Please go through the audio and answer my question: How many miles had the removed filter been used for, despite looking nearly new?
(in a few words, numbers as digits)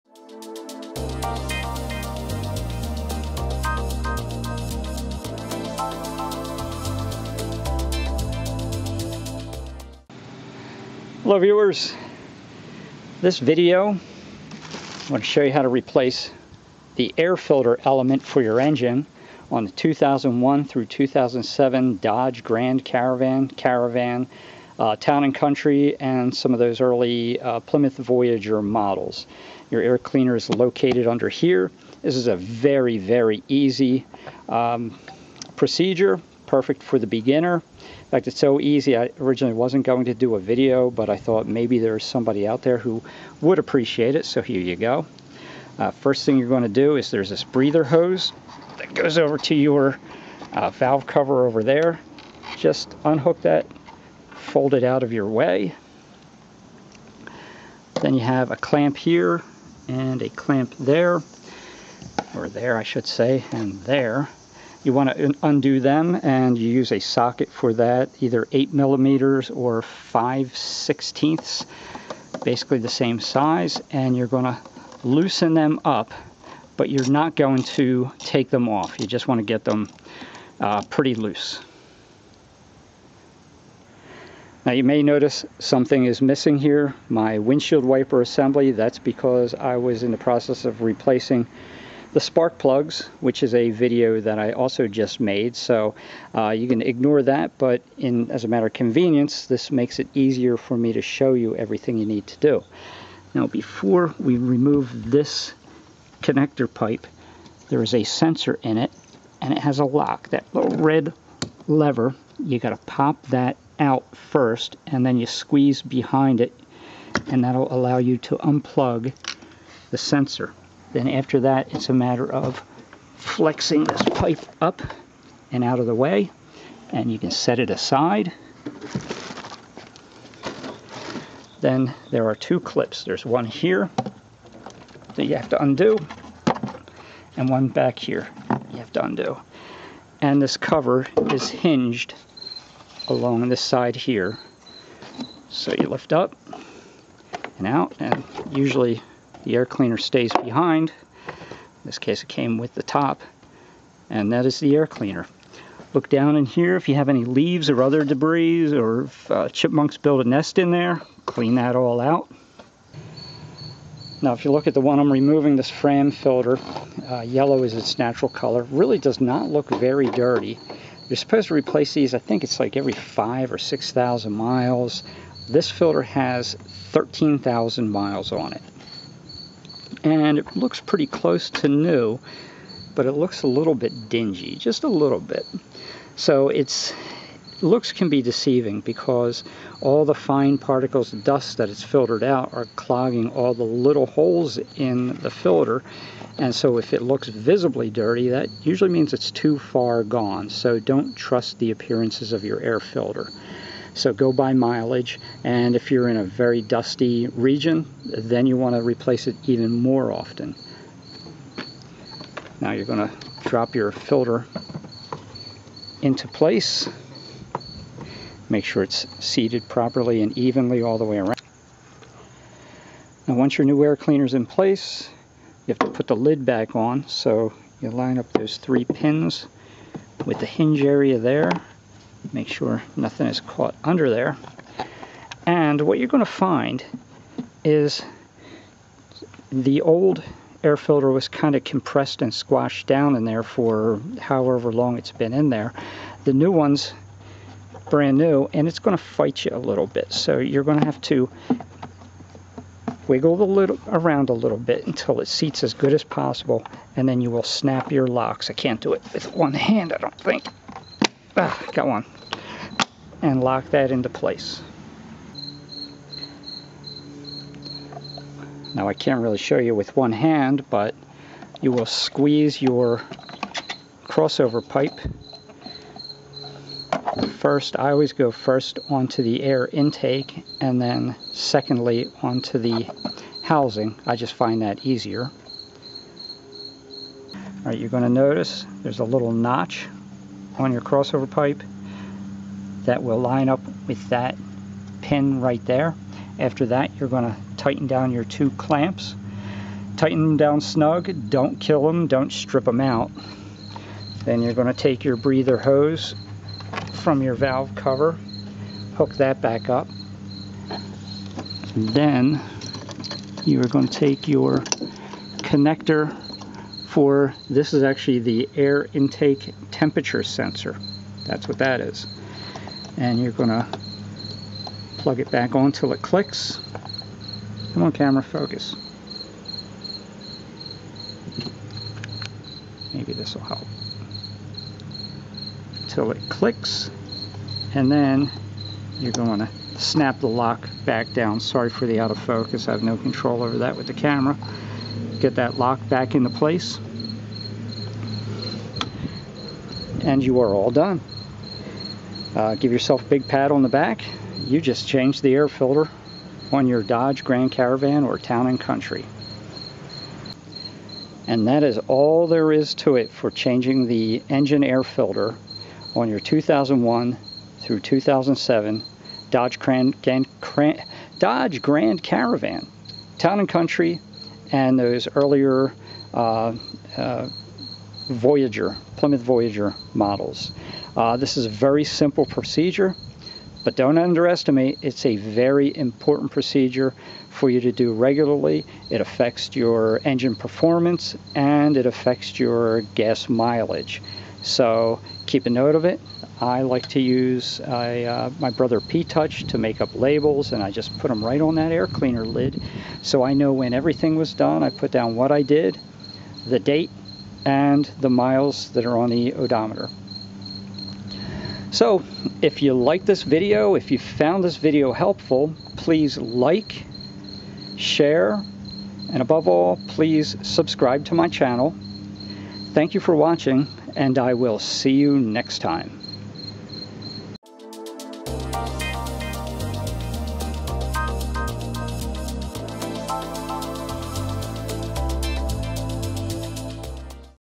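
13,000.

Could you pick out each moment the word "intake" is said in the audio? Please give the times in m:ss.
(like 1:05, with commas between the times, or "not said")
4:39, 5:18.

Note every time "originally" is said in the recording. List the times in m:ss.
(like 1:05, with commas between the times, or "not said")
0:39.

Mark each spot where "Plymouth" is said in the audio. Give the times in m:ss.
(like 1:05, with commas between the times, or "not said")
0:27, 6:18.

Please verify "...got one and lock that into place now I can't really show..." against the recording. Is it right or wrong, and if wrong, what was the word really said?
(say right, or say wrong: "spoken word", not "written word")
right.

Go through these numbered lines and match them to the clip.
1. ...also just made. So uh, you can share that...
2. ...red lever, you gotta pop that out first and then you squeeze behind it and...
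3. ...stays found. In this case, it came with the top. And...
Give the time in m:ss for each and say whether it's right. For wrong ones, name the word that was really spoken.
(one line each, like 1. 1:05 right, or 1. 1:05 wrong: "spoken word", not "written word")
1. 1:34 wrong: "ignore", not "share"
2. 1:50 right
3. 2:29 wrong: "behind", not "found".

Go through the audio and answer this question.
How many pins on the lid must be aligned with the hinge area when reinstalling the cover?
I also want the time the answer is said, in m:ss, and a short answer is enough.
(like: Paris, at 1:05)
3, at 3:48.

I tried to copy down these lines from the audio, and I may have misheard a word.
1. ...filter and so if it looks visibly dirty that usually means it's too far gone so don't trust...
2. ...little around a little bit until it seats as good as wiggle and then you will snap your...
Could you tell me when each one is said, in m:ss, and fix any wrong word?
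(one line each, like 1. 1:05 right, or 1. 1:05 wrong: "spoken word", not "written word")
1. 3:15 right
2. 4:13 wrong: "possible", not "wiggle".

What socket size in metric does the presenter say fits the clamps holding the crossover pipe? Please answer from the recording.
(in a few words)
8 millimeters.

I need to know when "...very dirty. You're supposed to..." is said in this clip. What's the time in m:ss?
2:49.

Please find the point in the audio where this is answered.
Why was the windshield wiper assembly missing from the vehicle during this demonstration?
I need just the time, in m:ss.
1:30.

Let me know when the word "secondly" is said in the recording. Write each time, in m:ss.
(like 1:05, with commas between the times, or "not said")
4:41.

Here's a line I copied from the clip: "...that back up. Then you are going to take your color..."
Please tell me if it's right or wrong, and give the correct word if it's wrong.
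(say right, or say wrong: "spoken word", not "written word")
wrong: "connector", not "color".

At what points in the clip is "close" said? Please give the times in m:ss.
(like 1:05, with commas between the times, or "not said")
3:01.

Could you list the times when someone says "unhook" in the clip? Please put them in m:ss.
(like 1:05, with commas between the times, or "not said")
0:53.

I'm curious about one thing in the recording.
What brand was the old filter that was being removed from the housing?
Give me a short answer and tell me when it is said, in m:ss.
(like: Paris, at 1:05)
Fram, at 2:45.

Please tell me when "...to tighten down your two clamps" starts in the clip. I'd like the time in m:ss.
4:57.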